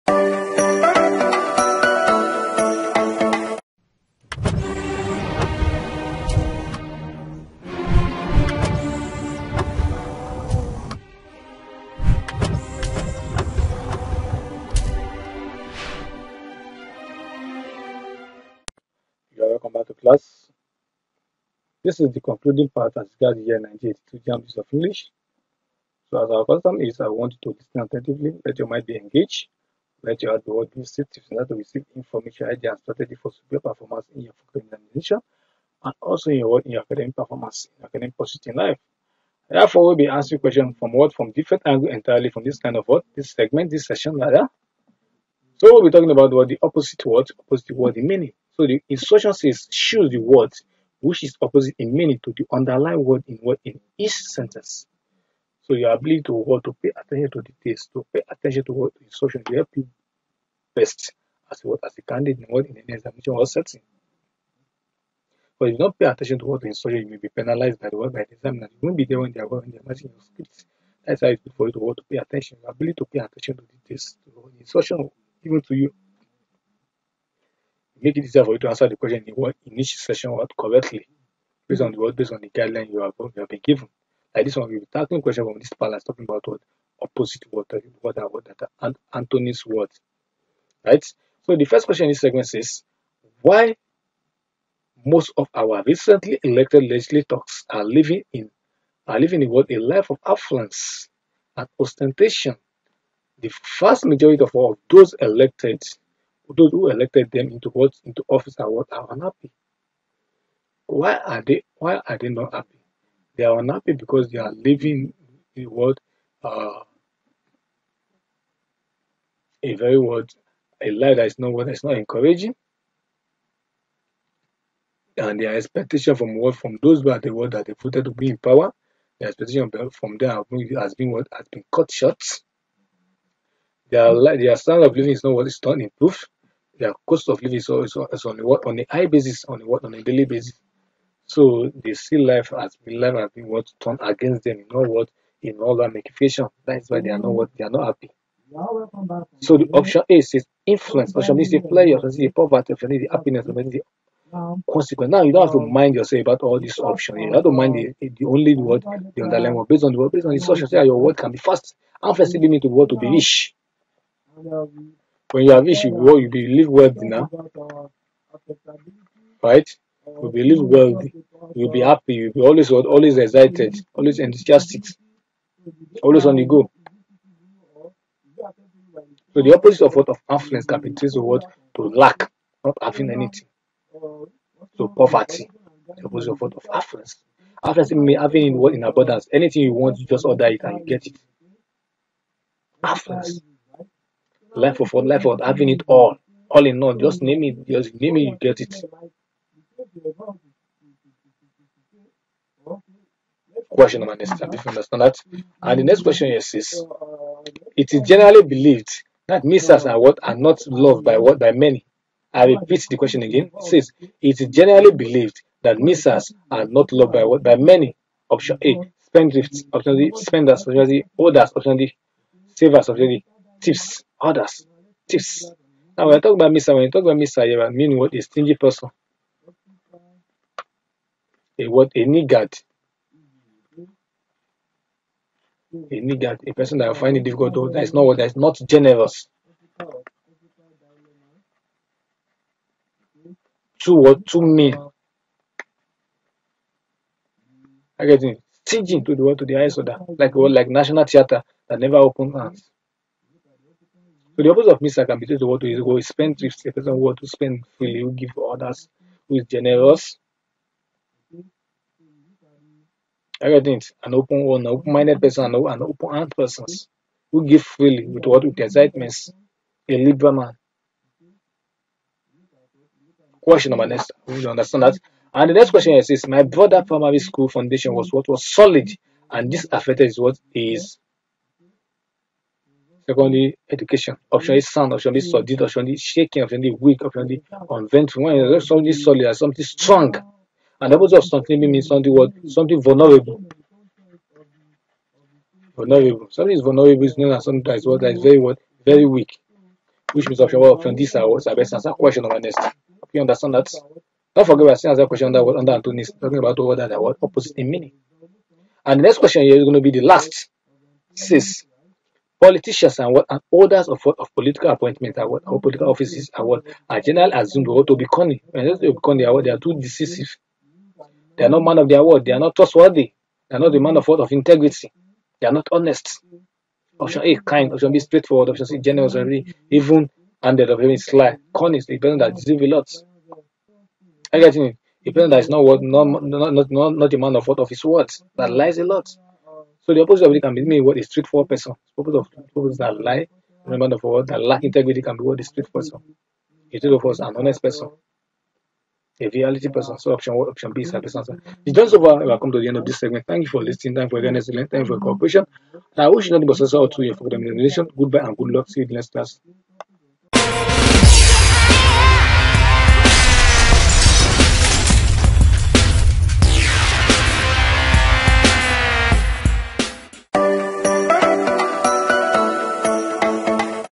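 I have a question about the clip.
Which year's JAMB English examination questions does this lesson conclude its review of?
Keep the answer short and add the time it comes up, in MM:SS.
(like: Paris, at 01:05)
1982, at 00:23.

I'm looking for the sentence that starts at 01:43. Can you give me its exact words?
The vast majority of all those elected those who elected them into what into office are what are unhappy.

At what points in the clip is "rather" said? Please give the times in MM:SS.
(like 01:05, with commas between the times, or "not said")
00:44.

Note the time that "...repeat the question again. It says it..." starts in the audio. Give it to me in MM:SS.
03:32.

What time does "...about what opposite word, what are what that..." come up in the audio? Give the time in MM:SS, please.
01:26.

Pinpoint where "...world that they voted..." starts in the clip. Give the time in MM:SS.
02:07.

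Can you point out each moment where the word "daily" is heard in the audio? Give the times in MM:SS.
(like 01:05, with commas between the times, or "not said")
02:20.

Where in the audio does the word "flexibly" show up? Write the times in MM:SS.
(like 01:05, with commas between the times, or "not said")
02:42.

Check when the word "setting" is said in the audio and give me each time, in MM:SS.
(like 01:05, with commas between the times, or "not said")
01:03.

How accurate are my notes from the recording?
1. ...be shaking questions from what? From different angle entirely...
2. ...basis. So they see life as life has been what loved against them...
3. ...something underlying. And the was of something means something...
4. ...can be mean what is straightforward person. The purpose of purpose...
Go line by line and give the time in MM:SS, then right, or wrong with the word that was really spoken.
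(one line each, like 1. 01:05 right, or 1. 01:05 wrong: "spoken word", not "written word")
1. 00:39 wrong: "asking", not "shaking"
2. 02:20 wrong: "turned", not "loved"
3. 04:49 wrong: "strong", not "underlying"
4. 05:40 right.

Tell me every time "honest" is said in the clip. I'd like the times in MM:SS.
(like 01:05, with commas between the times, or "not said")
05:25, 05:47.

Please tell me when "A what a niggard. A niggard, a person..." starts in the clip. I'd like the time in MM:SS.
03:51.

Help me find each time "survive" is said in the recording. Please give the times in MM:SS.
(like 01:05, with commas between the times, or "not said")
not said.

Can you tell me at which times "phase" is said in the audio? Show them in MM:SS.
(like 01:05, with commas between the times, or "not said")
not said.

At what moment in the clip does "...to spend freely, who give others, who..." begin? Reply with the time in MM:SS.
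04:17.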